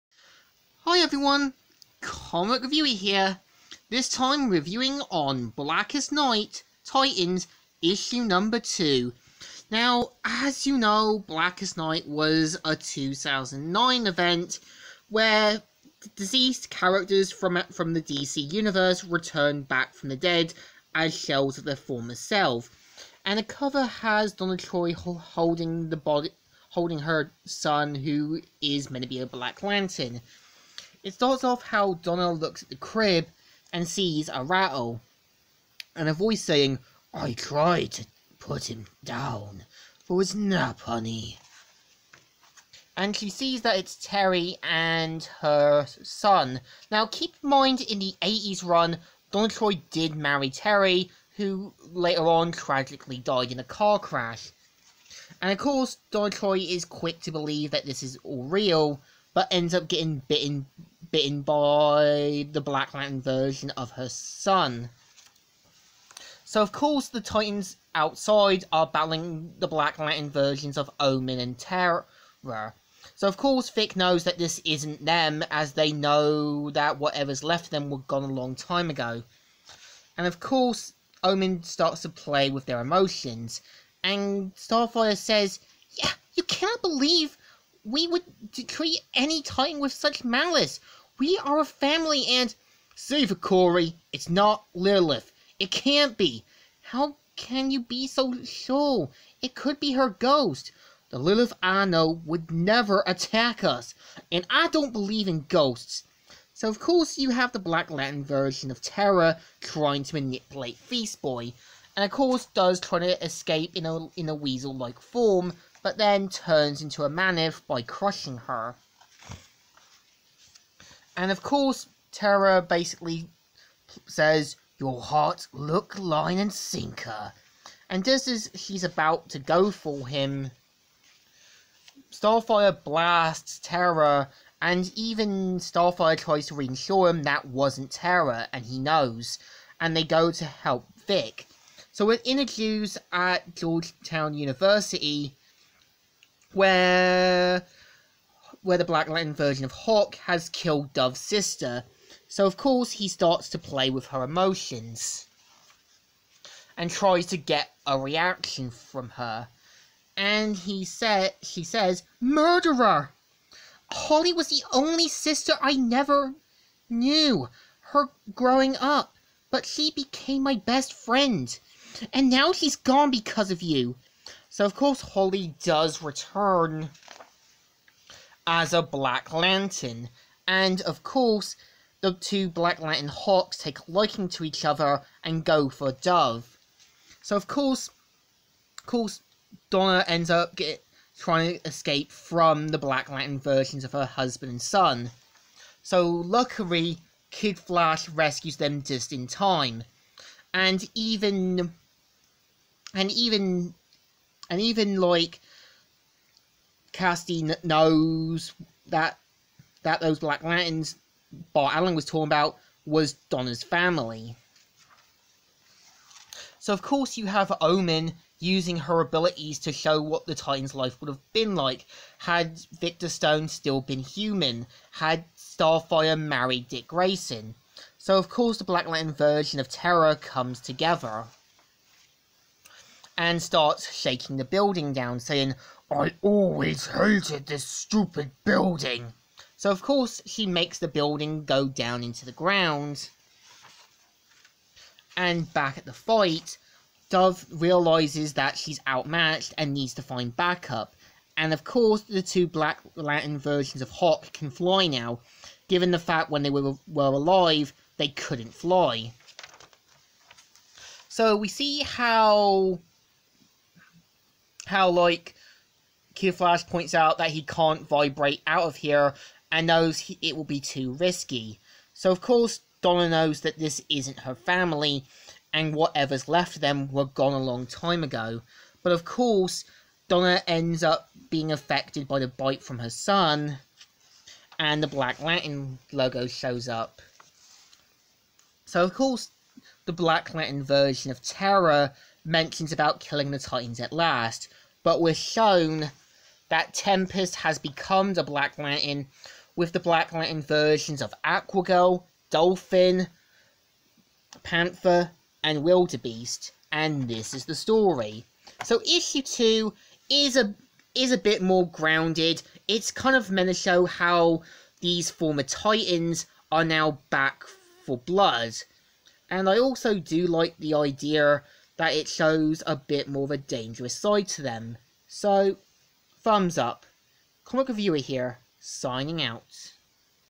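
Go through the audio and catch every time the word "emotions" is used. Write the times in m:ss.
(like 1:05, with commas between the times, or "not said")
1:22, 2:34.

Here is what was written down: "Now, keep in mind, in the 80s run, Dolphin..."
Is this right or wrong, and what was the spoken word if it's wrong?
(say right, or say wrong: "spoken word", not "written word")
wrong: "Donna", not "Dolphin".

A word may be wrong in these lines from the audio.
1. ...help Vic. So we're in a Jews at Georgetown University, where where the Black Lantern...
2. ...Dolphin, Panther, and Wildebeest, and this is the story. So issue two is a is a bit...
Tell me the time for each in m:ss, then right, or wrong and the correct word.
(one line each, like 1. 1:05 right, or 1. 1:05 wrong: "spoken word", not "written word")
1. 2:20 right
2. 5:02 right.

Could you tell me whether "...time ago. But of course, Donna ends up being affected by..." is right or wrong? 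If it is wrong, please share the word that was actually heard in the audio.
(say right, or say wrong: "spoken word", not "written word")
right.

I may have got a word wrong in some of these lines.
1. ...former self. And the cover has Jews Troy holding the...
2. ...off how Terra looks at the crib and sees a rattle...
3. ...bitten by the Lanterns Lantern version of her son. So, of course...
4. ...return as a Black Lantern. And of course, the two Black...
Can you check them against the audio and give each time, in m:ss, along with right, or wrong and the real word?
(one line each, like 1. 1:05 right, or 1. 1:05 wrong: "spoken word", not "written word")
1. 0:21 wrong: "Donna", not "Jews"
2. 0:31 wrong: "Donna", not "Terra"
3. 1:01 wrong: "Black", not "Lanterns"
4. 2:56 right.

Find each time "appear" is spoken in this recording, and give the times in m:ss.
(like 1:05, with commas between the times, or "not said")
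not said.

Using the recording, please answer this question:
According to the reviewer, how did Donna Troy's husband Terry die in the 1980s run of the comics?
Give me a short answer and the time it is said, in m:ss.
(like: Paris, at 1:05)
A car crash, at 0:53.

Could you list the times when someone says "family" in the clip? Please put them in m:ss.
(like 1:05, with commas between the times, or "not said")
1:31, 3:33, 4:34.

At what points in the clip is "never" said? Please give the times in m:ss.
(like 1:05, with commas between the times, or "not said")
1:42, 2:45.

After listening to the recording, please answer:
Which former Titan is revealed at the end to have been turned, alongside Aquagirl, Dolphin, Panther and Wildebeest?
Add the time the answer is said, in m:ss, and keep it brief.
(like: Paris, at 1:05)
Tempest, at 4:56.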